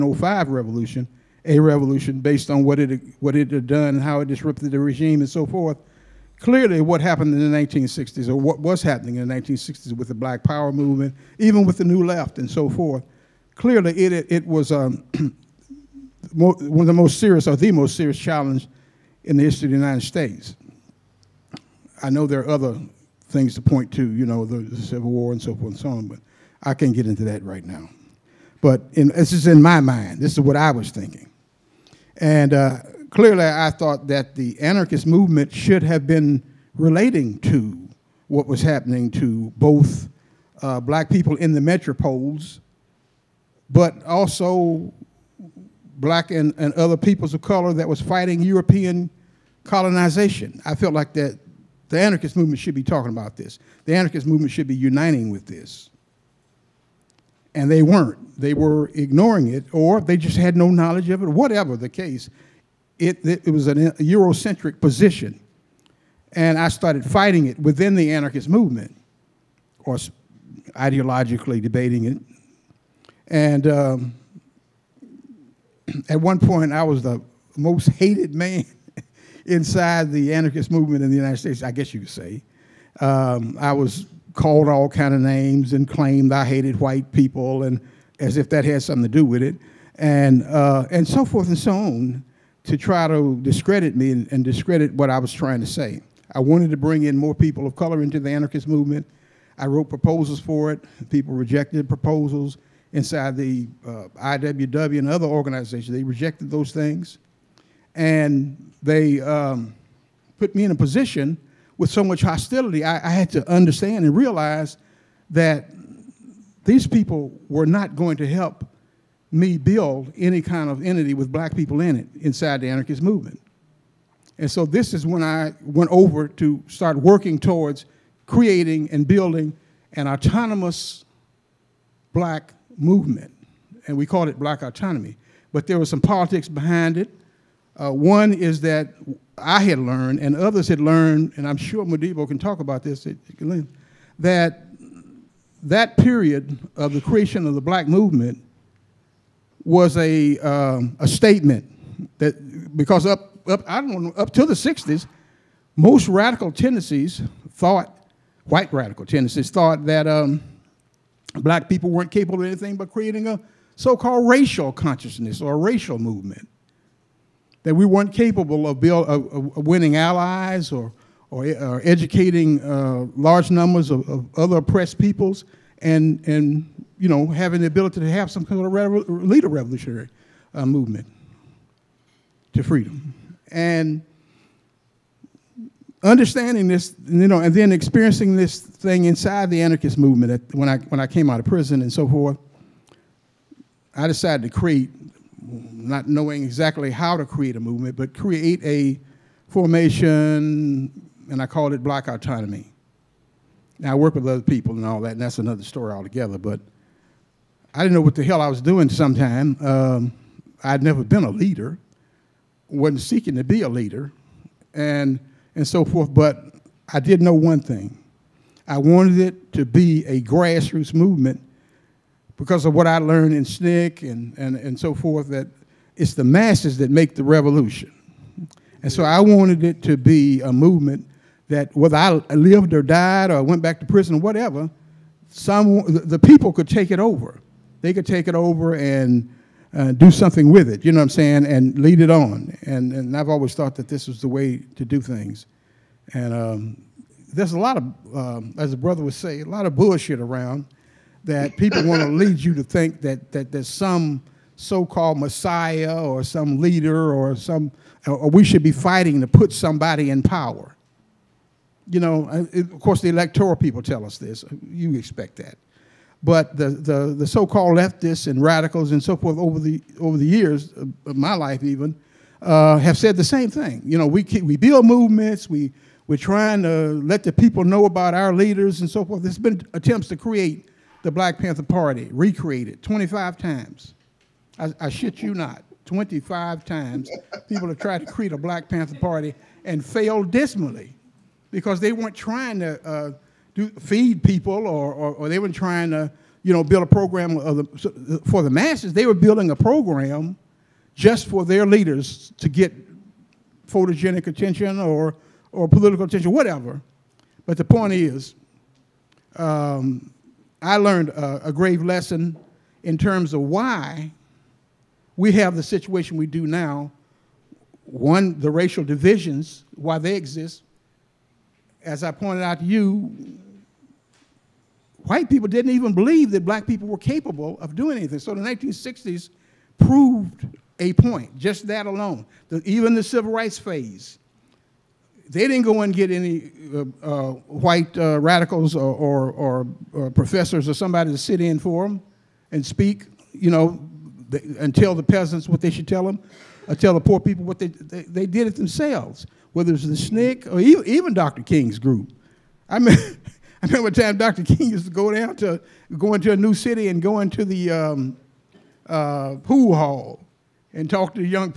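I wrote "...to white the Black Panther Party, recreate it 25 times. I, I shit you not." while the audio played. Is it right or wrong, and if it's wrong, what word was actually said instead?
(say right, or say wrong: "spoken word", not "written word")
wrong: "create", not "white".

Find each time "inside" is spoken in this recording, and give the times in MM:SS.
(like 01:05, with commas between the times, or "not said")
01:19, 01:42, 02:02, 03:09.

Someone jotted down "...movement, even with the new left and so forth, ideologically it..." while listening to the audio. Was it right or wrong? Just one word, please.
wrong.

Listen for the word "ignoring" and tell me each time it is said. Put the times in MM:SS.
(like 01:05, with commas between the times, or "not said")
00:58.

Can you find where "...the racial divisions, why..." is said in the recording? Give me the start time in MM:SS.
05:18.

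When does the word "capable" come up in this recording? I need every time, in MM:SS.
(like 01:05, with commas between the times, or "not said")
02:42, 02:48, 05:26.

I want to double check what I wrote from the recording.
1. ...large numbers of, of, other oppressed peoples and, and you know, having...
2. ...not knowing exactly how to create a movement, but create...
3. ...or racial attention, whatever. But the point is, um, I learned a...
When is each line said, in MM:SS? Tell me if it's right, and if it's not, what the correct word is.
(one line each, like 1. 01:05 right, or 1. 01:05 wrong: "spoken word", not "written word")
1. 02:53 right
2. 03:15 right
3. 05:05 wrong: "political", not "racial".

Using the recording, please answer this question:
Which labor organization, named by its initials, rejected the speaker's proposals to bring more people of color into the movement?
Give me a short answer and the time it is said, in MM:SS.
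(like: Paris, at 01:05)
IWW, at 01:44.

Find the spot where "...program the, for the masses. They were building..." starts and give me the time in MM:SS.
04:56.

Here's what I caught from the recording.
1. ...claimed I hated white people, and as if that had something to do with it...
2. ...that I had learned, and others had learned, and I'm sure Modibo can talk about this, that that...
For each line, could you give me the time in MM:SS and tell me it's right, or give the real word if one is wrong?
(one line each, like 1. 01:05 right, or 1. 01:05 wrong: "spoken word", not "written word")
1. 01:25 right
2. 02:18 right.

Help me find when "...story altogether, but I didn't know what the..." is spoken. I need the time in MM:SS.
03:25.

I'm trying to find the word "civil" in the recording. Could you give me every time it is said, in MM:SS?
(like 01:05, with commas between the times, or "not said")
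00:24, 05:33.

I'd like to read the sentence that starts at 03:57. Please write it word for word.
They could take it over and uh, do something with it, you know what I'm saying, and lead it on.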